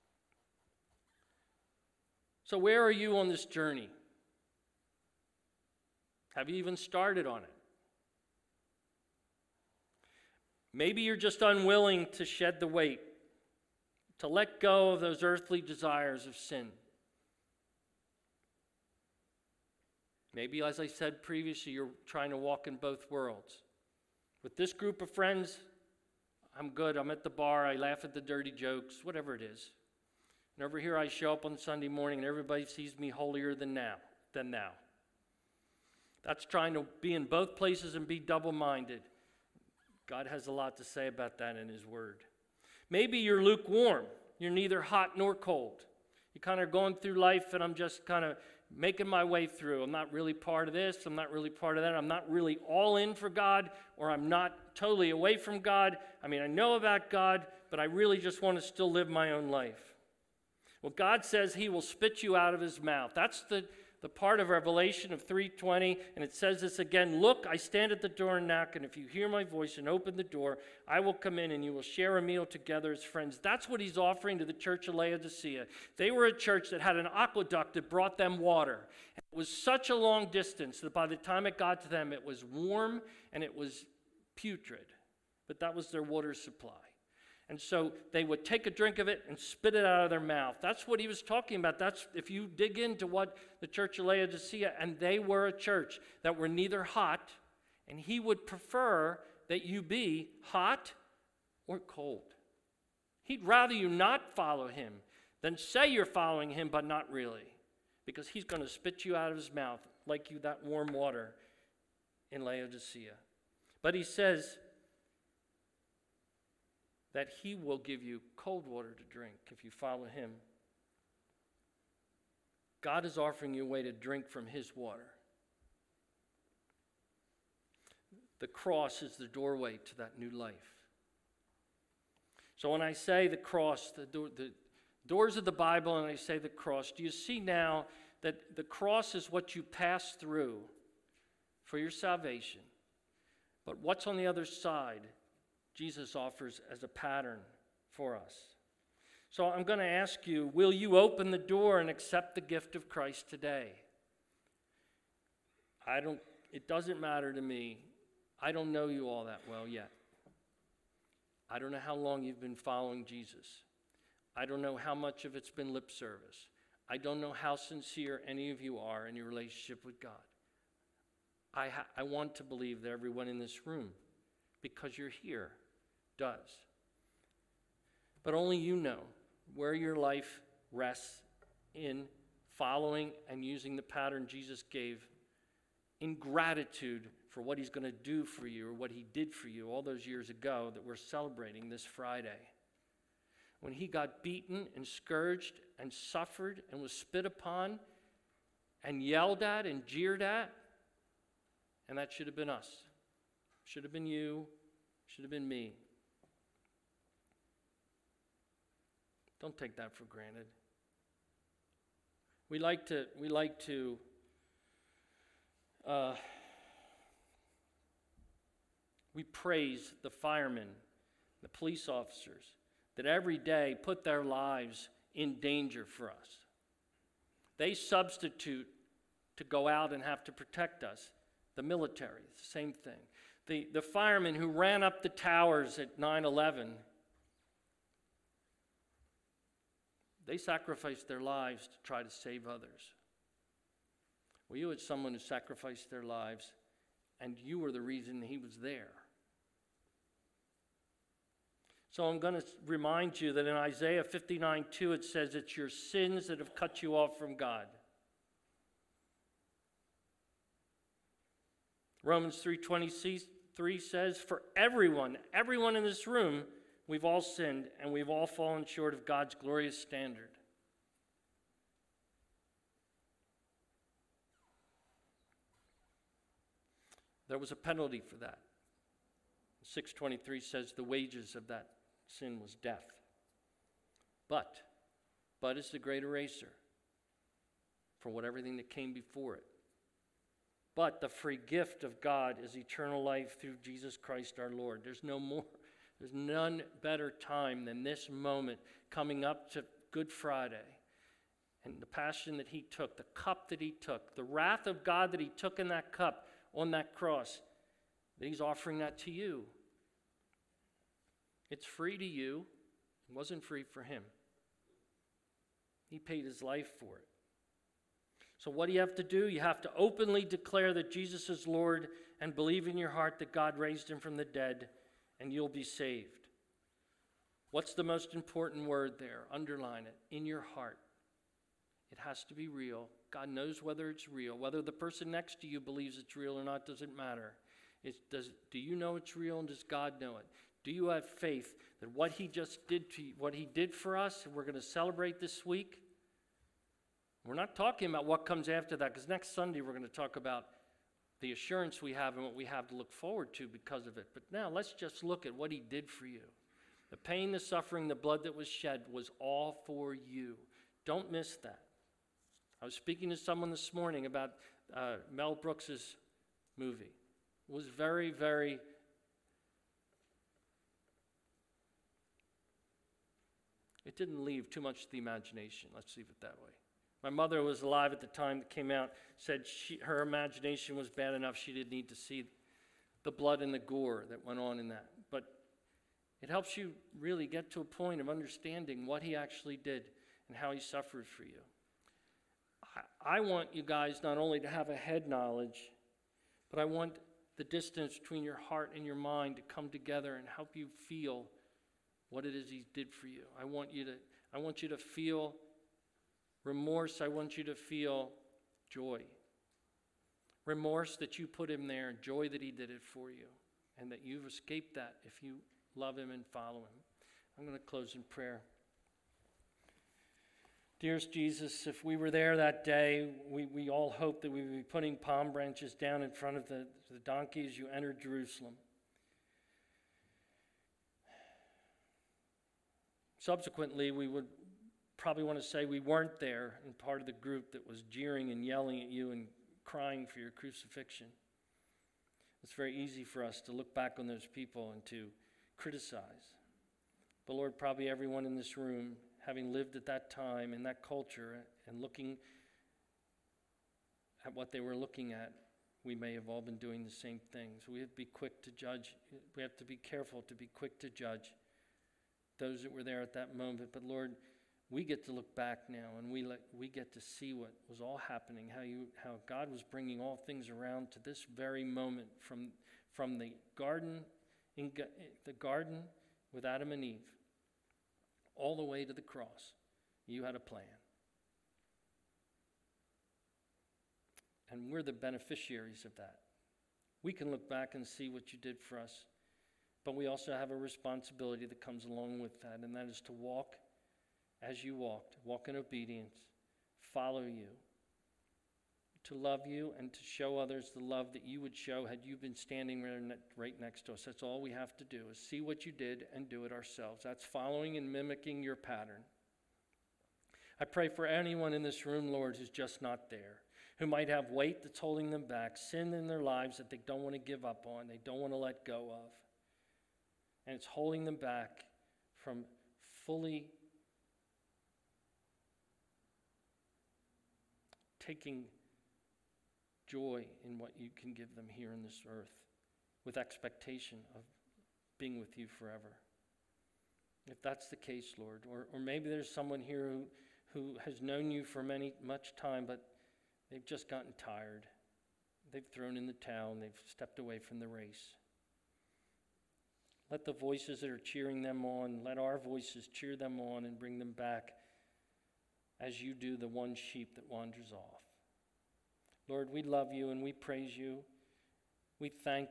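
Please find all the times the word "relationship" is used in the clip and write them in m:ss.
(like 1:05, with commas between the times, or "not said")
2:49.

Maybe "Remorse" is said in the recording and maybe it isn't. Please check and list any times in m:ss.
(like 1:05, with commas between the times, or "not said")
6:46, 6:50.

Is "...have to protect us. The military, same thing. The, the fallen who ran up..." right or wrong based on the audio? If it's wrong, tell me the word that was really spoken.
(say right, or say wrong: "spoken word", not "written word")
wrong: "firemen", not "fallen".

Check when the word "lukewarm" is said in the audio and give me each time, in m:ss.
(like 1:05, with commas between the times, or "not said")
0:43.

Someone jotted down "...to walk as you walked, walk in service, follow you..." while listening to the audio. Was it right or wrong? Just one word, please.
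wrong.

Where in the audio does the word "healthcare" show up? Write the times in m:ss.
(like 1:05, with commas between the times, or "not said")
not said.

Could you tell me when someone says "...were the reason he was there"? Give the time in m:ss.
4:07.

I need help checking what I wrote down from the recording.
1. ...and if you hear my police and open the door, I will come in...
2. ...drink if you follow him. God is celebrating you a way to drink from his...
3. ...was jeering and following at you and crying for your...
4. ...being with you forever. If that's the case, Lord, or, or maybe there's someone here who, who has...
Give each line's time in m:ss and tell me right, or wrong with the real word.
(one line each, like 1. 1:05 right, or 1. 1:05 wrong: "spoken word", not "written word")
1. 1:08 wrong: "voice", not "police"
2. 1:59 wrong: "offering", not "celebrating"
3. 7:17 wrong: "yelling", not "following"
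4. 8:54 right.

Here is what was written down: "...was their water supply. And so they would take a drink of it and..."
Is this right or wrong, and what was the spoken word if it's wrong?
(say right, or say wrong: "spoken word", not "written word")
right.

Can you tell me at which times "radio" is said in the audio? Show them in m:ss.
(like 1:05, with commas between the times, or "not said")
not said.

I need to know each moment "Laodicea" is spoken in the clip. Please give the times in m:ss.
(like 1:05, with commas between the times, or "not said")
1:14, 1:34, 1:52.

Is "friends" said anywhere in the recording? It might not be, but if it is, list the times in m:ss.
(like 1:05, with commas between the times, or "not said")
0:25, 1:13.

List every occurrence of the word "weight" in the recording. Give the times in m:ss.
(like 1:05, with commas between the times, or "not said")
0:12, 8:34.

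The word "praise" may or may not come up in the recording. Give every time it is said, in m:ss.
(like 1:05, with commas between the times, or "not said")
3:39, 9:20.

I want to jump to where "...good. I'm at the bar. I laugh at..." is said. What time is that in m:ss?
0:26.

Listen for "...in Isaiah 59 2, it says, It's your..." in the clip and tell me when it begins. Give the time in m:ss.
4:13.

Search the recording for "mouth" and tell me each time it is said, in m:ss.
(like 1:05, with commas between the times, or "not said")
1:02, 1:30, 1:49.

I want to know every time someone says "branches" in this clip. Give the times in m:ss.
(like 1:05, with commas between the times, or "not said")
7:05.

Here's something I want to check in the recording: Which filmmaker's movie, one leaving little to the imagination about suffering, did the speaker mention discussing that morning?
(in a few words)
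Mel Brooks.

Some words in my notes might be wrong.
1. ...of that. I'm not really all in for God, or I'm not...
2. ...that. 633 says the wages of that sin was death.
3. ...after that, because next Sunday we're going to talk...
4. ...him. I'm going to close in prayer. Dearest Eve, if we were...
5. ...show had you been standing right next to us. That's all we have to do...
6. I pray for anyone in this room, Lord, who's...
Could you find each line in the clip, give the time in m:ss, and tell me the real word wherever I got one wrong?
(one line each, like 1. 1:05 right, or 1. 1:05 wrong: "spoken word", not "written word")
1. 0:51 right
2. 4:38 wrong: "623", not "633"
3. 5:48 right
4. 6:56 wrong: "Jesus", not "Eve"
5. 8:21 right
6. 8:30 right.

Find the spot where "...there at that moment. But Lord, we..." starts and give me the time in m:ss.
7:42.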